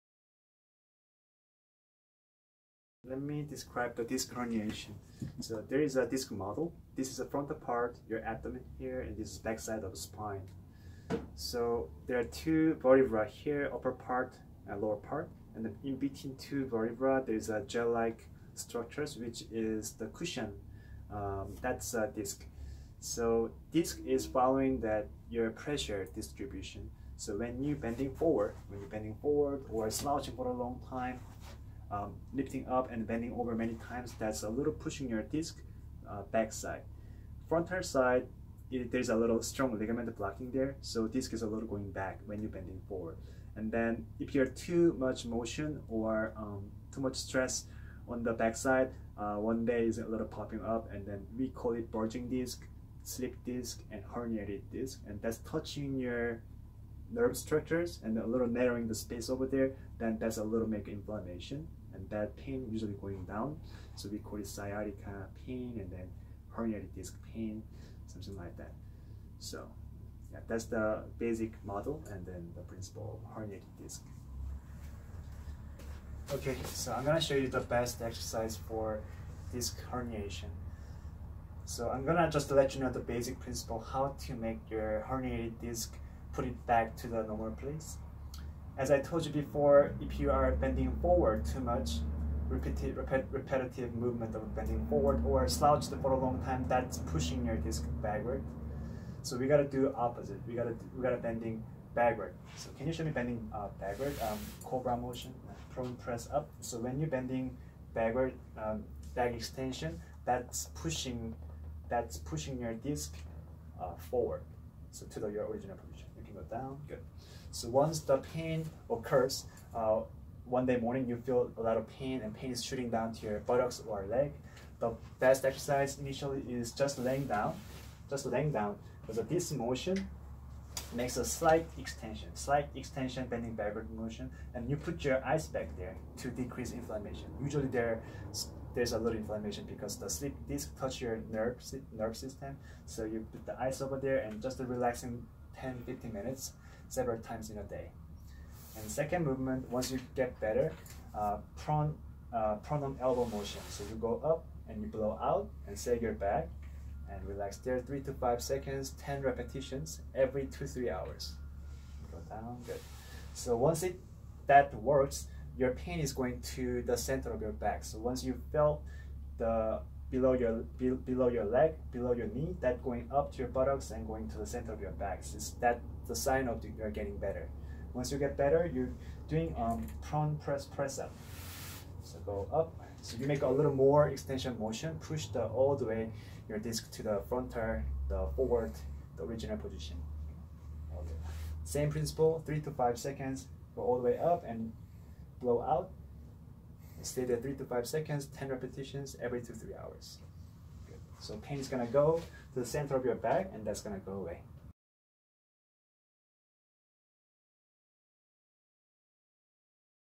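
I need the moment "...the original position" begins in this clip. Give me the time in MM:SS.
03:09.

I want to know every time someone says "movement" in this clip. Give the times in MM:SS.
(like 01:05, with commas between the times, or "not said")
01:33, 02:29.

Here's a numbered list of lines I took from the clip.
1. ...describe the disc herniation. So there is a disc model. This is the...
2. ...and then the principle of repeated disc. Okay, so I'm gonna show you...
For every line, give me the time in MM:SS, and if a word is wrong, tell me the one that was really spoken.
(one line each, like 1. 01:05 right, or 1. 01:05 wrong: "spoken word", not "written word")
1. 00:03 right
2. 01:12 wrong: "herniated", not "repeated".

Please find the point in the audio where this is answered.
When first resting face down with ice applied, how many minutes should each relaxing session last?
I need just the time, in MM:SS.
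02:25.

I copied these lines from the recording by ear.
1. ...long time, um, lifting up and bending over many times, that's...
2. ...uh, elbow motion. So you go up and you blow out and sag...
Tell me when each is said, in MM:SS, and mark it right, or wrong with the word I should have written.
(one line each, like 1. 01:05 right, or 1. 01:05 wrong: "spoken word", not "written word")
1. 00:30 right
2. 02:32 right.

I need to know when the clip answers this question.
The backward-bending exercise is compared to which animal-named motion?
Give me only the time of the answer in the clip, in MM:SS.
01:44.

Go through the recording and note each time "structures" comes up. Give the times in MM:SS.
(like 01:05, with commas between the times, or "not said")
00:18, 00:57.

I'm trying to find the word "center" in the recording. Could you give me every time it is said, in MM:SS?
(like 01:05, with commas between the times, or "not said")
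02:46, 02:54, 03:22.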